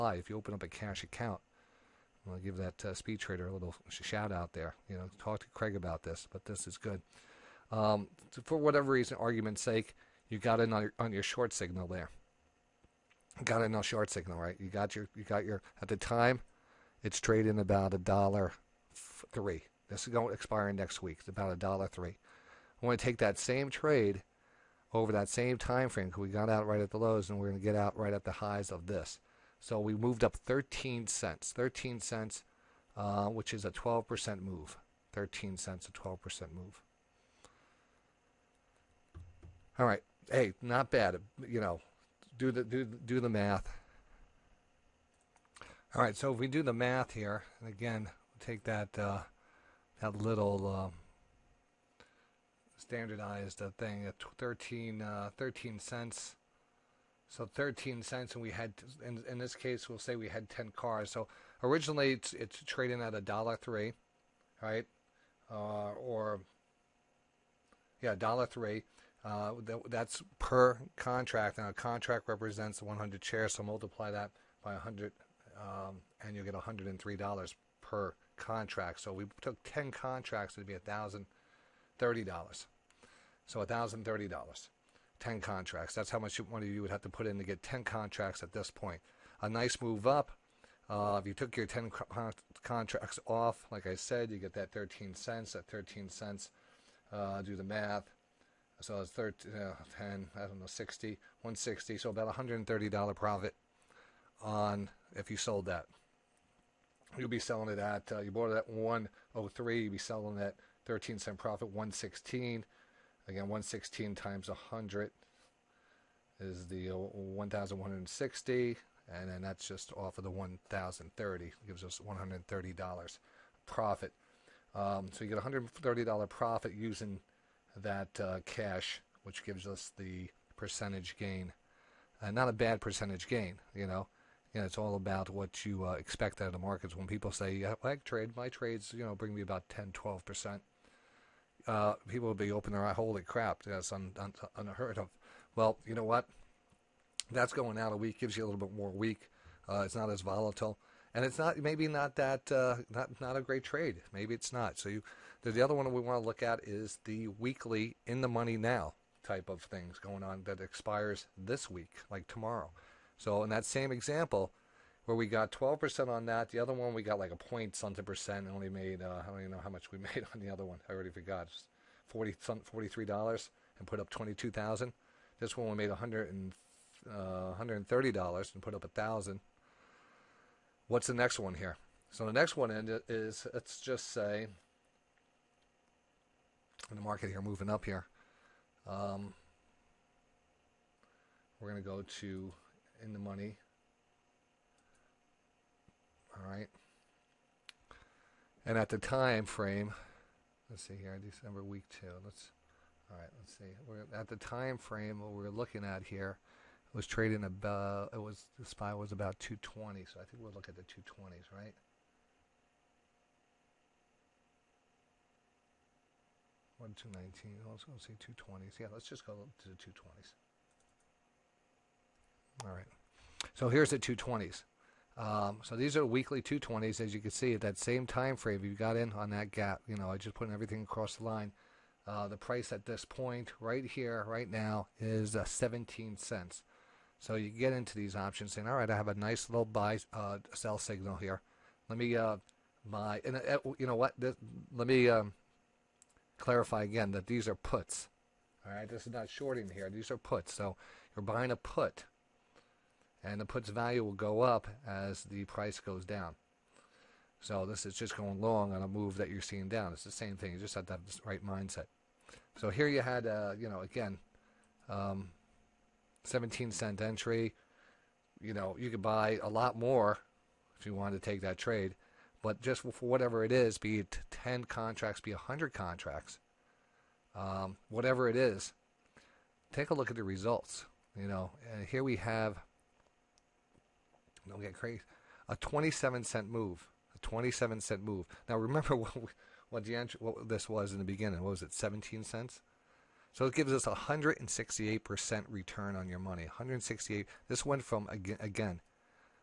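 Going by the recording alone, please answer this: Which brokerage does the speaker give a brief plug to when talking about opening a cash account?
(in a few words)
SpeedTrader.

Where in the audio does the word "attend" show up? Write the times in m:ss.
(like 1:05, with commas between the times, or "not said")
not said.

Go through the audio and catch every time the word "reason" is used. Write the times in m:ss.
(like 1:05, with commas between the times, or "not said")
0:08.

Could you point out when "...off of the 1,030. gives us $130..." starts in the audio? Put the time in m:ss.
1:59.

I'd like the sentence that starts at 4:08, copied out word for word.
All right, this is not shorting here.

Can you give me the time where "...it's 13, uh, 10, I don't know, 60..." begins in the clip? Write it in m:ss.
1:39.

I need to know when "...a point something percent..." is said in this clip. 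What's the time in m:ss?
2:47.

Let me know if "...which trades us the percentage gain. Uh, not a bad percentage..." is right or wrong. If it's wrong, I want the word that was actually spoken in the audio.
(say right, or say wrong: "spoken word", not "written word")
wrong: "gives", not "trades".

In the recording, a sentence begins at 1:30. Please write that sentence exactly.
Uh, if you took your 10 contracts off, like I said, you get that 13 cents.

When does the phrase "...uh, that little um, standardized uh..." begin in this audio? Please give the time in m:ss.
0:48.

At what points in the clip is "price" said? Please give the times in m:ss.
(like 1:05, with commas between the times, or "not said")
3:52, 4:15.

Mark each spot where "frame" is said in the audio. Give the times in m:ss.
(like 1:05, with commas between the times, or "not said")
0:25, 3:19, 3:24, 3:48.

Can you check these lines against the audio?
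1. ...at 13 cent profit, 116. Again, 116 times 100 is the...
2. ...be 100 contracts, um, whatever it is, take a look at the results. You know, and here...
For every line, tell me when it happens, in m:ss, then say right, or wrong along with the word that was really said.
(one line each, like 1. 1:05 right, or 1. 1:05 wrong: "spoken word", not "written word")
1. 1:50 right
2. 4:35 right.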